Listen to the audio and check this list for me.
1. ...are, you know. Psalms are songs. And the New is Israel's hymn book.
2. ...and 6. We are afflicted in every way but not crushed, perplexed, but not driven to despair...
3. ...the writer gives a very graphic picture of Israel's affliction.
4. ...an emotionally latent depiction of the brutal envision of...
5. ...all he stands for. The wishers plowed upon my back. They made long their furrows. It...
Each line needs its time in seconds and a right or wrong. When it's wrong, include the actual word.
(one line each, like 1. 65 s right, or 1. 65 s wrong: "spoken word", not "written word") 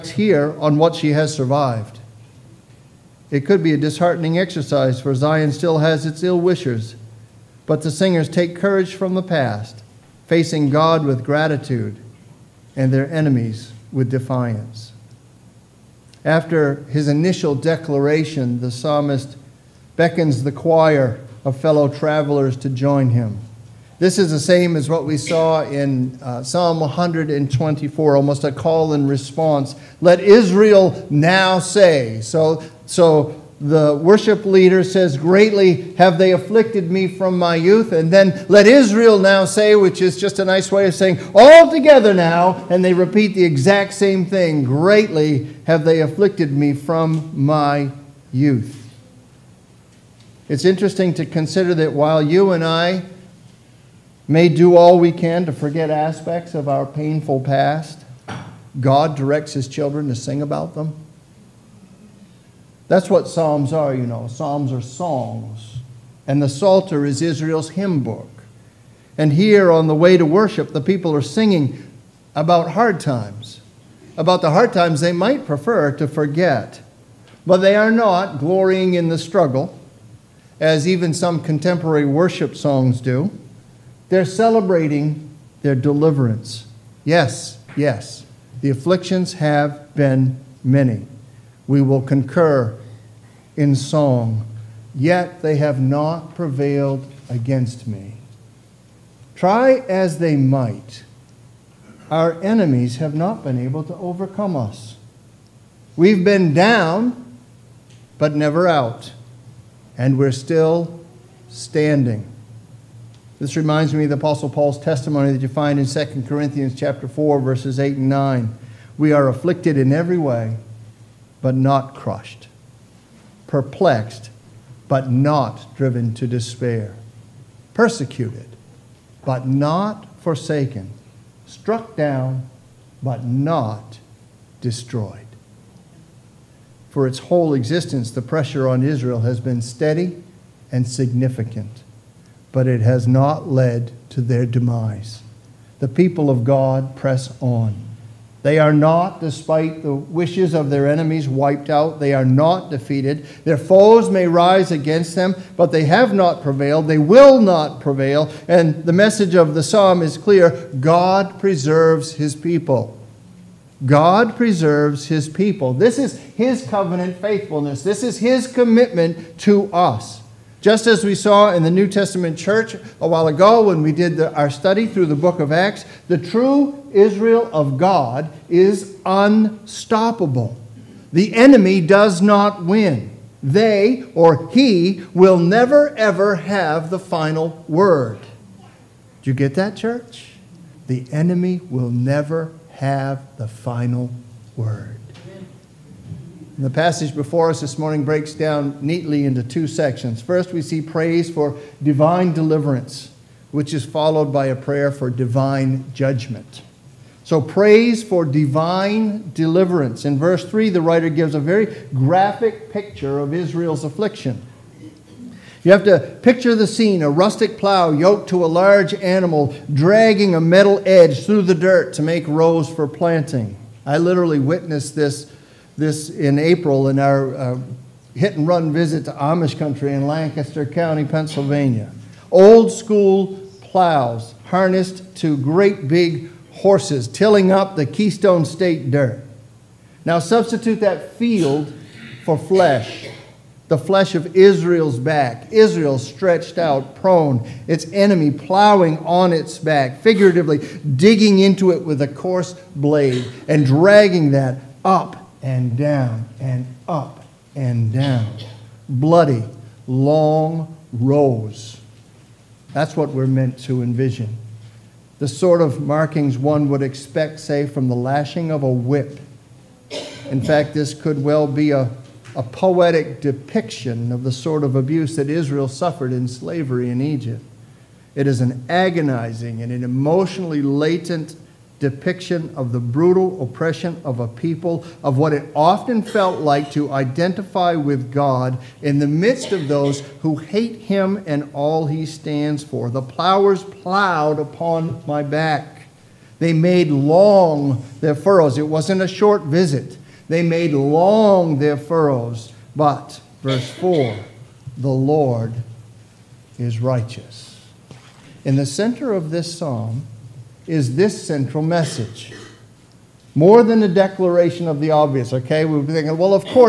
1. 63 s wrong: "Psalter", not "New"
2. 117 s wrong: "9", not "6"
3. 210 s right
4. 279 s wrong: "oppression", not "envision"
5. 291 s wrong: "plowers", not "wishers".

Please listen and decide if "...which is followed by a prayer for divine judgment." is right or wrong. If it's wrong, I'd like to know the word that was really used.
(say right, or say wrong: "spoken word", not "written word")
right.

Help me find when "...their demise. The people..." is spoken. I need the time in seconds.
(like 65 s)
144 s.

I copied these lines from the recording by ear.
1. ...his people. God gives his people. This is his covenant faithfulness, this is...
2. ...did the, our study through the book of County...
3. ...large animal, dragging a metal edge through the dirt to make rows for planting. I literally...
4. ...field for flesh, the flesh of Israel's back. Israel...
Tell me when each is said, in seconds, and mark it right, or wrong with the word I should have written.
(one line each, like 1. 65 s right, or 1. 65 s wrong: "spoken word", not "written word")
1. 162 s wrong: "preserves", not "gives"
2. 173 s wrong: "Acts", not "County"
3. 218 s right
4. 241 s right.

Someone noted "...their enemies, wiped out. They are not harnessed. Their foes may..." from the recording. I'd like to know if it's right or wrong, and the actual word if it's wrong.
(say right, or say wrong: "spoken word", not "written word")
wrong: "defeated", not "harnessed".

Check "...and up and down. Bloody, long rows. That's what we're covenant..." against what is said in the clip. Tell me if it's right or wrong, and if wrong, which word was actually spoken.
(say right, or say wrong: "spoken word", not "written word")
wrong: "meant", not "covenant".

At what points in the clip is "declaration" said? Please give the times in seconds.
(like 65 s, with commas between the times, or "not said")
17 s, 313 s.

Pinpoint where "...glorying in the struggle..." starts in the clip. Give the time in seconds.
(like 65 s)
78 s.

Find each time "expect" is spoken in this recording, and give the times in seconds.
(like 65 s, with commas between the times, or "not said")
266 s.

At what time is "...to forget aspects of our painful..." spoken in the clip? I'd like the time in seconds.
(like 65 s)
55 s.